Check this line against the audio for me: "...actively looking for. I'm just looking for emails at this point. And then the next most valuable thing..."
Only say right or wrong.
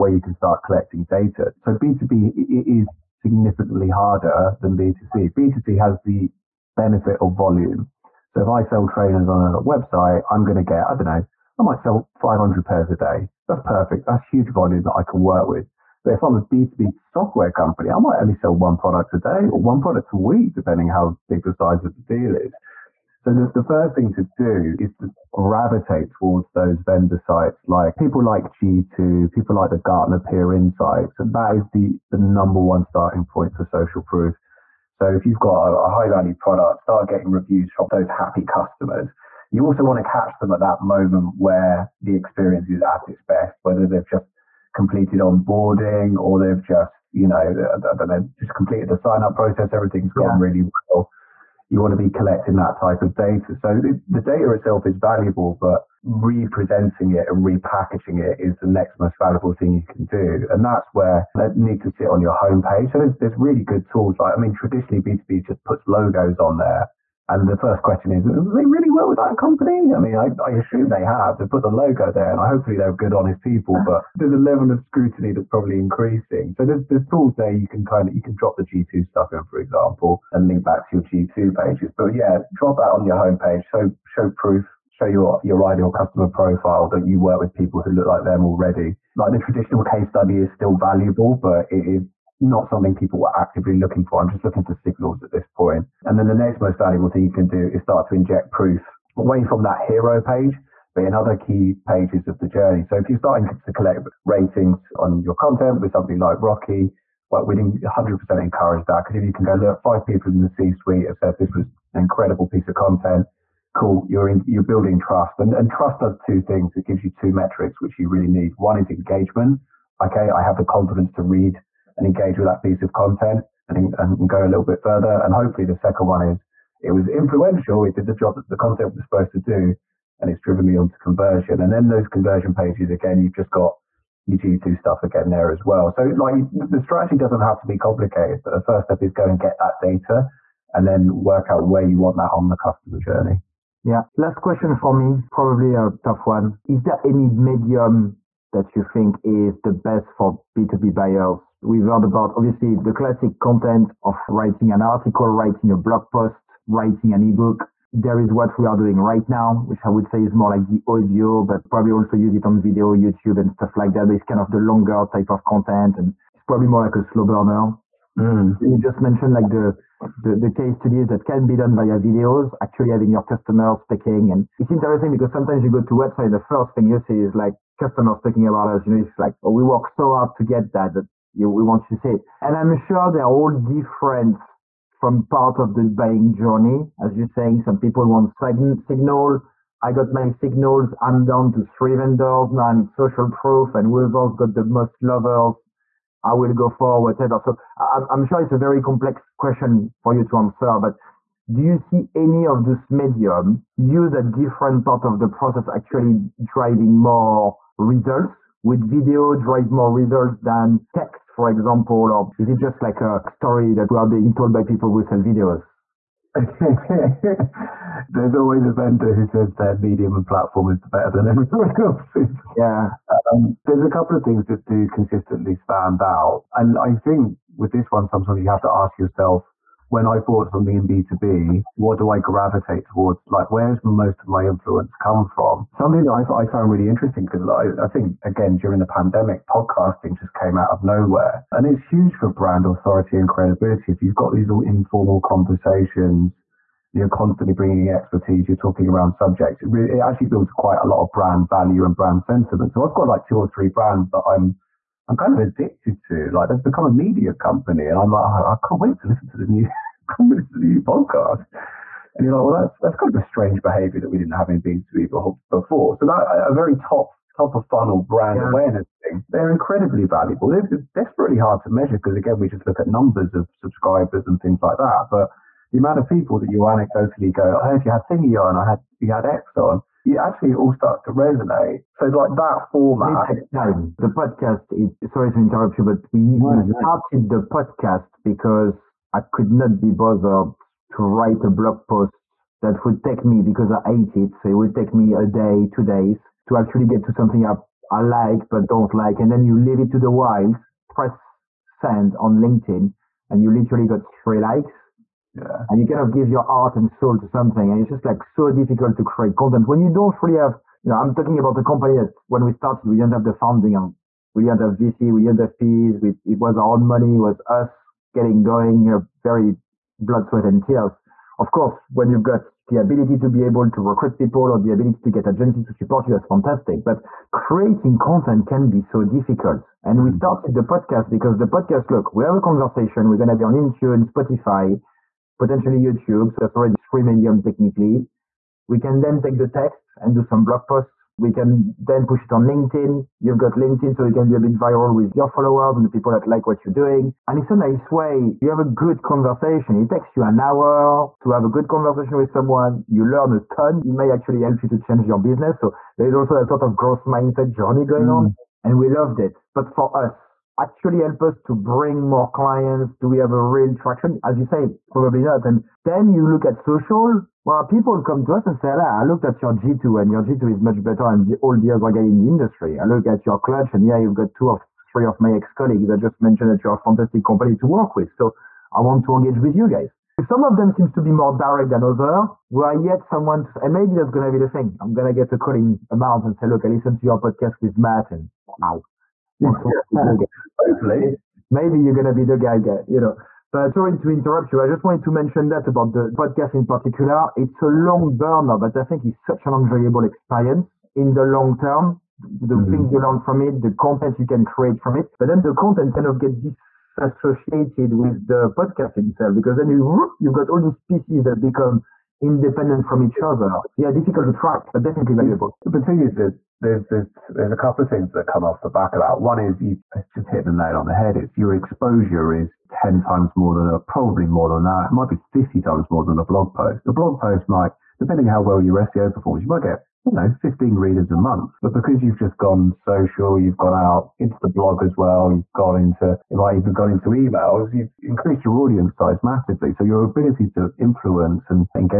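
wrong.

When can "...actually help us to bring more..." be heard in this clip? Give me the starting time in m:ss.
6:00.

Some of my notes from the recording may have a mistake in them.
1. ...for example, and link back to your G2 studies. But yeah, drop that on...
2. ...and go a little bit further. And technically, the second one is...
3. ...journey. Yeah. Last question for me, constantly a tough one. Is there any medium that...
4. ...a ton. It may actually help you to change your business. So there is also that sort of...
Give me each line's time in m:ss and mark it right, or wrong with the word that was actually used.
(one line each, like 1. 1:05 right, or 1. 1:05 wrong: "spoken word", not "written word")
1. 1:19 wrong: "pages", not "studies"
2. 2:03 wrong: "hopefully", not "technically"
3. 2:22 wrong: "probably", not "constantly"
4. 5:53 right.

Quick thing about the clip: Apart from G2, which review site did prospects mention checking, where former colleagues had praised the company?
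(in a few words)
Clutch.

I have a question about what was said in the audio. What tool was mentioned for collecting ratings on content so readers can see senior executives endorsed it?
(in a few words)
Rockee.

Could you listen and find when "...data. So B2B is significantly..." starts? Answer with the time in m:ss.
0:01.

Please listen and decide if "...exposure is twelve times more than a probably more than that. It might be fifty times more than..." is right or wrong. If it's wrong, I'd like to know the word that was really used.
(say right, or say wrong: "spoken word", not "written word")
wrong: "ten", not "twelve".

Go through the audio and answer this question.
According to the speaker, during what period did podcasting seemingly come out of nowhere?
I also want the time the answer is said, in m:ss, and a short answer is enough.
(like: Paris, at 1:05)
the pandemic, at 3:58.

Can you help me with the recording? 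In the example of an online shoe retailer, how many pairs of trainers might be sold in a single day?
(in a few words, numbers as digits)
500.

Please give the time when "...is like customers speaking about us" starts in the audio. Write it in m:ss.
2:57.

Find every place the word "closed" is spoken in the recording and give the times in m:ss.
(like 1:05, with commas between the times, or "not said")
not said.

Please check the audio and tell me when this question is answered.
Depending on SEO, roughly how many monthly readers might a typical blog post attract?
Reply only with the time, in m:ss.
7:10.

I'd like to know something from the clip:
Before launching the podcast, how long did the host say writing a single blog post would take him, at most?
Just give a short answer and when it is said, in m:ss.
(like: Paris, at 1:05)
two days, at 4:55.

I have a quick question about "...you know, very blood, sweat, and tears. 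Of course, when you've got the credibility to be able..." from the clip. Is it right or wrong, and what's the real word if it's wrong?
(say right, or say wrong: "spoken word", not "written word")
wrong: "ability", not "credibility".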